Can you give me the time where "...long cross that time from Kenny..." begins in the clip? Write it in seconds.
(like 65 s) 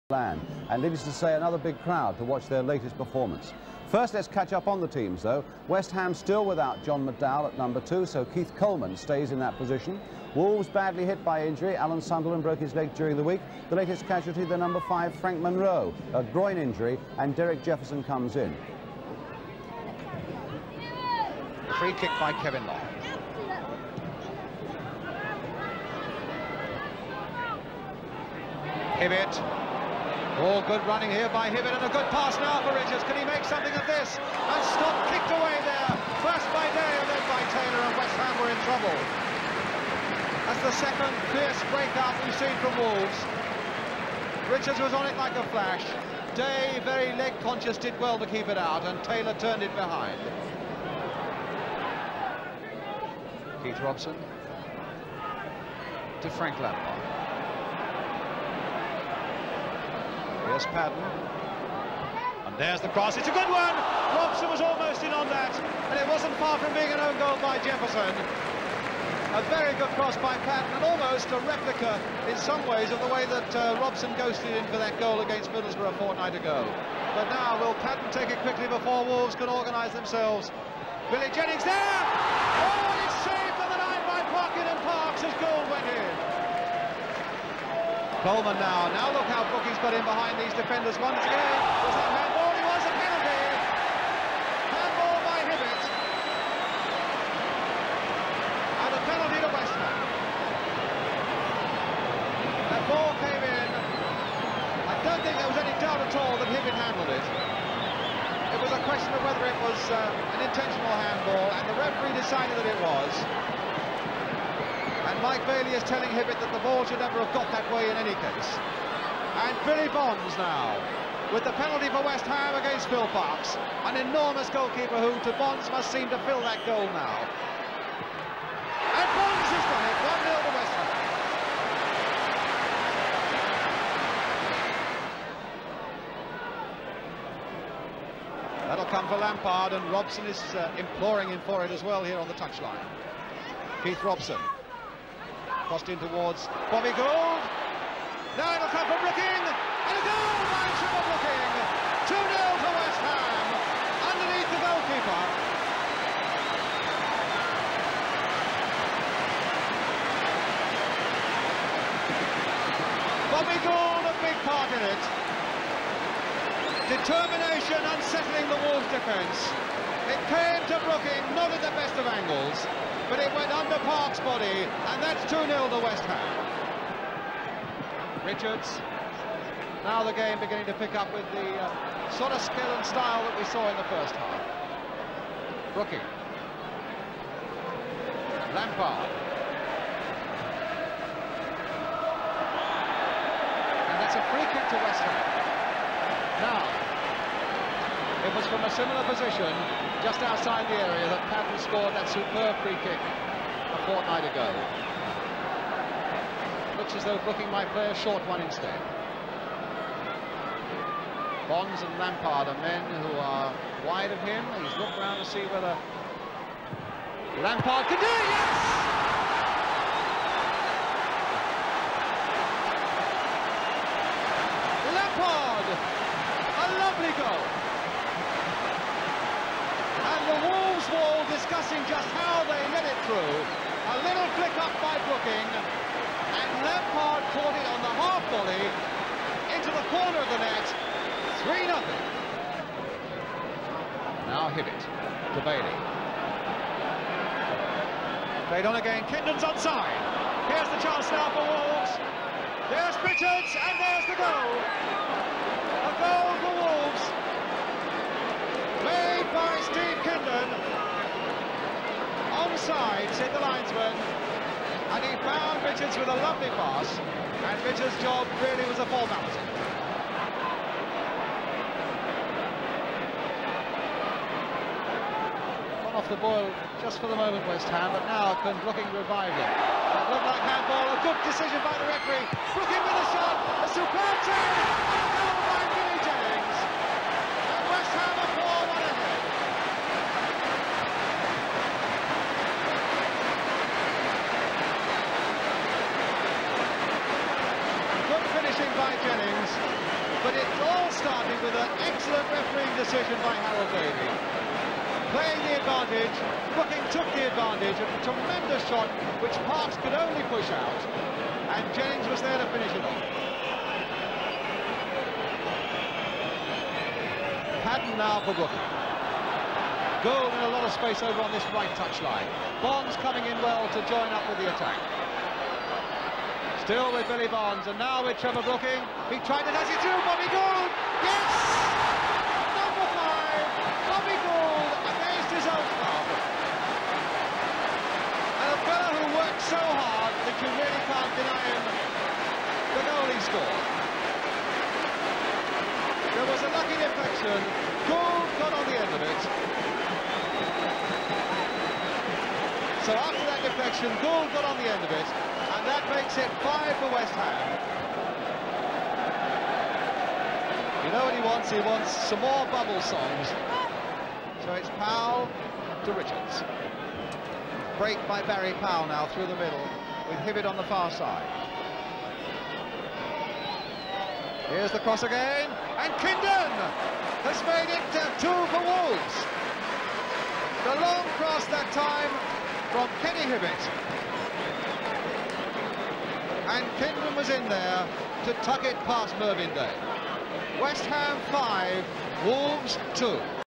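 380 s.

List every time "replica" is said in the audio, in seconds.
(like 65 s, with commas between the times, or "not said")
71 s.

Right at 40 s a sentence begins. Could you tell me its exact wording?
That's the second fierce breakout we've seen from Wolves.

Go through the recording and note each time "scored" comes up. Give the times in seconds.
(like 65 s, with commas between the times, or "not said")
201 s, 343 s.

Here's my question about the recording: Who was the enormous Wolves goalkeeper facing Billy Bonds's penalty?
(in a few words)
Phil Parkes.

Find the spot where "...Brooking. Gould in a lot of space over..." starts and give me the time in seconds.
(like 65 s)
318 s.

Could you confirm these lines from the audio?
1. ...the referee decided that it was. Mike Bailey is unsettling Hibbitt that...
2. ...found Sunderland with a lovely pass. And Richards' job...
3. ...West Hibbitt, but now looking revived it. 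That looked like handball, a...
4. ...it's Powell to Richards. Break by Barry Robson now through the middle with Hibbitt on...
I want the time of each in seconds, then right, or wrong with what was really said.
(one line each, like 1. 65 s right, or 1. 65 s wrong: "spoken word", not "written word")
1. 111 s wrong: "telling", not "unsettling"
2. 265 s wrong: "Richards", not "Sunderland"
3. 277 s wrong: "Ham", not "Hibbitt"
4. 364 s wrong: "Powell", not "Robson".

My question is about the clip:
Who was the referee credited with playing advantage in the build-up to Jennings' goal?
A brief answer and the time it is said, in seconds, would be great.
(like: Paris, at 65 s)
Harold Davey, at 303 s.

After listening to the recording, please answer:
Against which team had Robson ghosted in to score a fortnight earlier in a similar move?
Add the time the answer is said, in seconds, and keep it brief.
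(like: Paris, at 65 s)
Middlesbrough, at 75 s.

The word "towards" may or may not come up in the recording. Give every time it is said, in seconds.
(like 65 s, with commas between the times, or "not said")
146 s.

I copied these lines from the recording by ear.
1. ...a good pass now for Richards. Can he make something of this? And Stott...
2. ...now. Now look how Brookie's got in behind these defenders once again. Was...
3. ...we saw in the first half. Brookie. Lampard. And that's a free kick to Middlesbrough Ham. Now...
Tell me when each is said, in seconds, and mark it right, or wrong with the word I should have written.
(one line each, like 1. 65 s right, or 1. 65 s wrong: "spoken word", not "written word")
1. 31 s right
2. 88 s right
3. 183 s wrong: "West", not "Middlesbrough".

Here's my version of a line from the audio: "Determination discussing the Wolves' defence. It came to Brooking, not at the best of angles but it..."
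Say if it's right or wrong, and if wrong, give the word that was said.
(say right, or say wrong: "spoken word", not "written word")
wrong: "unsettling", not "discussing".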